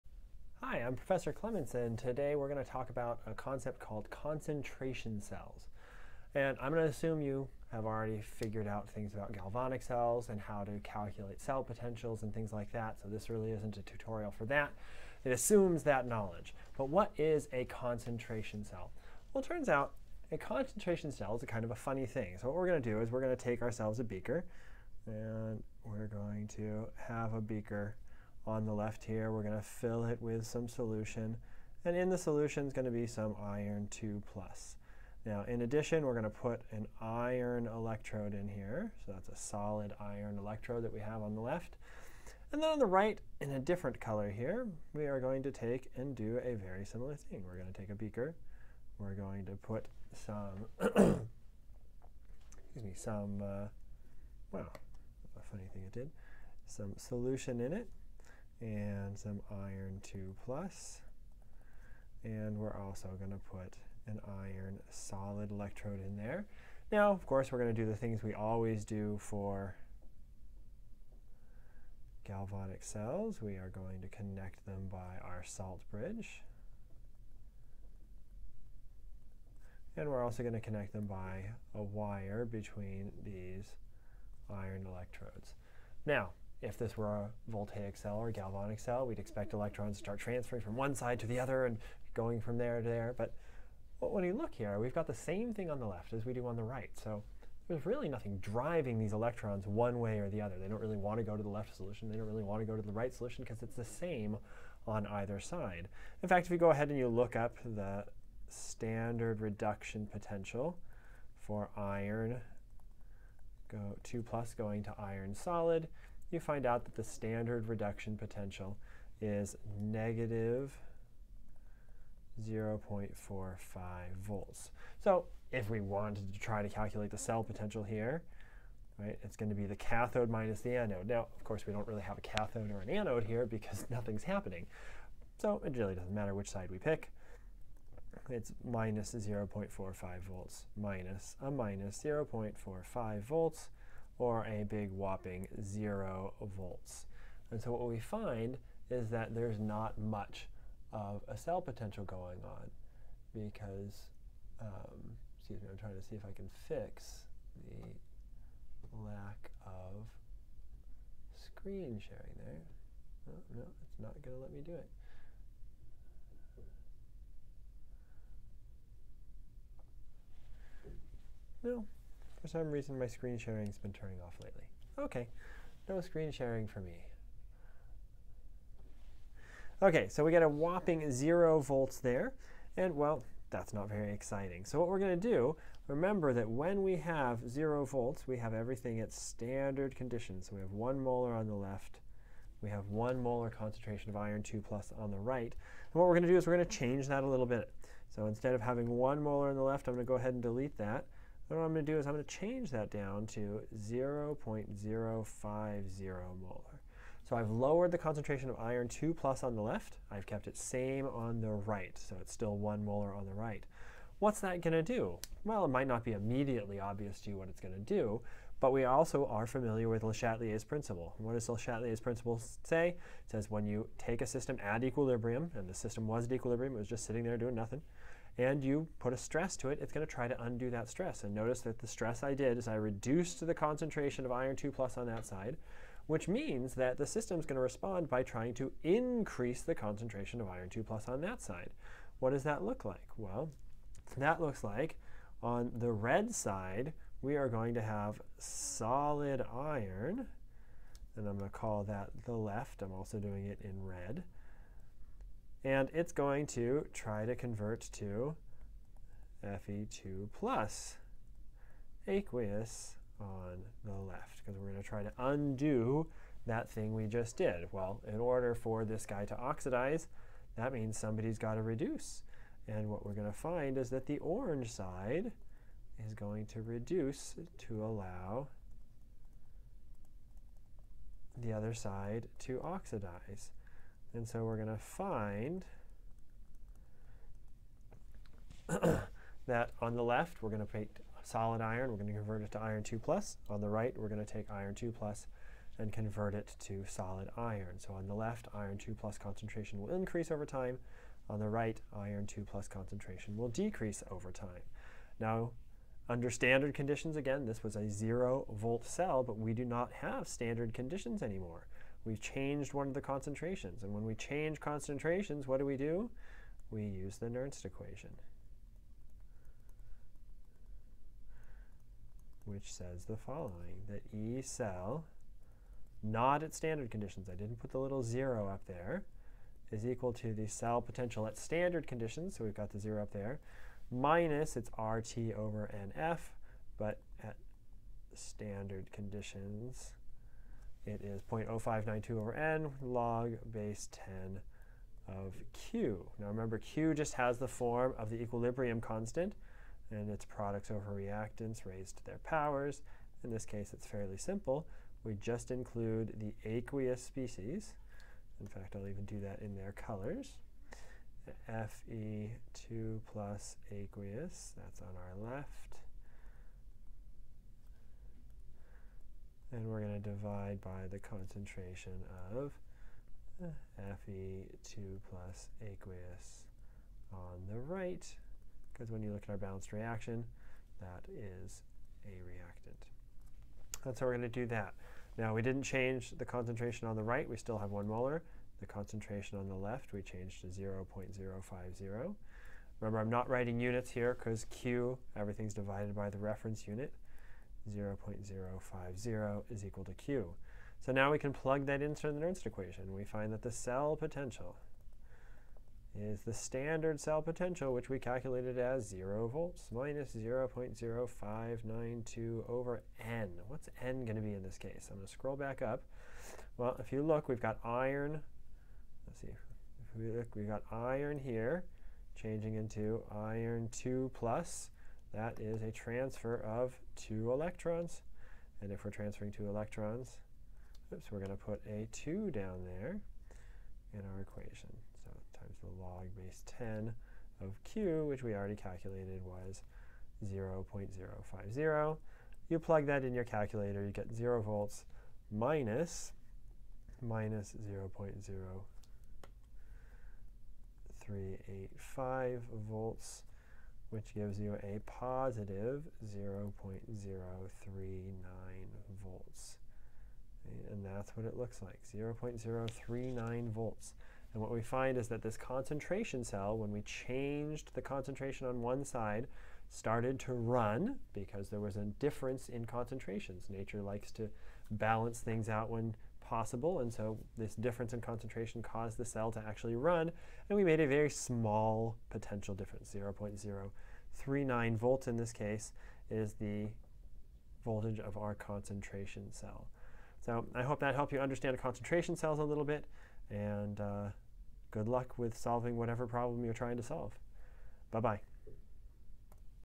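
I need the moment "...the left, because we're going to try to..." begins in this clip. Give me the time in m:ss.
4:23.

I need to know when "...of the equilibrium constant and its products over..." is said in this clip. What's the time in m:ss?
5:47.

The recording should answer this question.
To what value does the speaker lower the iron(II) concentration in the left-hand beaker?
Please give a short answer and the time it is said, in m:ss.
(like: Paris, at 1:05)
0.050 molar, at 3:23.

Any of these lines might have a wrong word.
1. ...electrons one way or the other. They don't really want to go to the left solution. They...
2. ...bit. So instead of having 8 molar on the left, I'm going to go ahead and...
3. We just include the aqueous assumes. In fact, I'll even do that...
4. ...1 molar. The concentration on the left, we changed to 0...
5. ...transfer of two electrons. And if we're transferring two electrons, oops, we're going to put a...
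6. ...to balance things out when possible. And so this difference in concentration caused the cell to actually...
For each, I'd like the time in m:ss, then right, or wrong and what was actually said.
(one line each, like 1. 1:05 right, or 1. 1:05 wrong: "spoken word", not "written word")
1. 1:39 right
2. 3:17 wrong: "1", not "8"
3. 5:55 wrong: "species", not "assumes"
4. 6:27 right
5. 7:05 right
6. 7:54 right.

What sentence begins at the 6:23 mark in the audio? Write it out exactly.
That's how we're going to do that.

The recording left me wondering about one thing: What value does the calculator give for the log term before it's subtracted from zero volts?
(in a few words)
-0.0385 volts.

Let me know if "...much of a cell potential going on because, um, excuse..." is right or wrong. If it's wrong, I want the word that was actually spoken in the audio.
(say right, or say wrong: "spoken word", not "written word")
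right.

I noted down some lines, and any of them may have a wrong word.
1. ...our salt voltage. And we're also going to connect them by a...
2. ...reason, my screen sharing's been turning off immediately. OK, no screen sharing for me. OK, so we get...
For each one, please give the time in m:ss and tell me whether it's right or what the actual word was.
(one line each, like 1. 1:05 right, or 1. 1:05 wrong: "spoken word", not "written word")
1. 1:15 wrong: "bridge", not "voltage"
2. 2:52 wrong: "lately", not "immediately".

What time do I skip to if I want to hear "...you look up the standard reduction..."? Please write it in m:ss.
1:46.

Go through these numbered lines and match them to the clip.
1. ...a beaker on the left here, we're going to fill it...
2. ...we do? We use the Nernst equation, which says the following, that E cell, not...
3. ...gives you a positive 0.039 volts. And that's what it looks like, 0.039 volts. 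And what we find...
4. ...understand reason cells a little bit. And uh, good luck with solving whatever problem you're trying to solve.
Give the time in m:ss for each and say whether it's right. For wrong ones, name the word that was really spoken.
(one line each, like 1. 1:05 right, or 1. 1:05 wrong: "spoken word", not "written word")
1. 0:27 right
2. 5:15 right
3. 7:34 right
4. 8:11 wrong: "concentration", not "reason".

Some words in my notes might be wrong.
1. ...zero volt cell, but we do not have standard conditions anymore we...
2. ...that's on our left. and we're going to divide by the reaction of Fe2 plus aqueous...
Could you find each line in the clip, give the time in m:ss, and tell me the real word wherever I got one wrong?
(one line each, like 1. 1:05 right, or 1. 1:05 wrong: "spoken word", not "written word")
1. 5:07 right
2. 6:04 wrong: "concentration", not "reaction".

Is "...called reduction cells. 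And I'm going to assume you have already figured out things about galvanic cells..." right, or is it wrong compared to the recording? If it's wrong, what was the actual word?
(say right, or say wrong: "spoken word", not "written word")
wrong: "concentration", not "reduction".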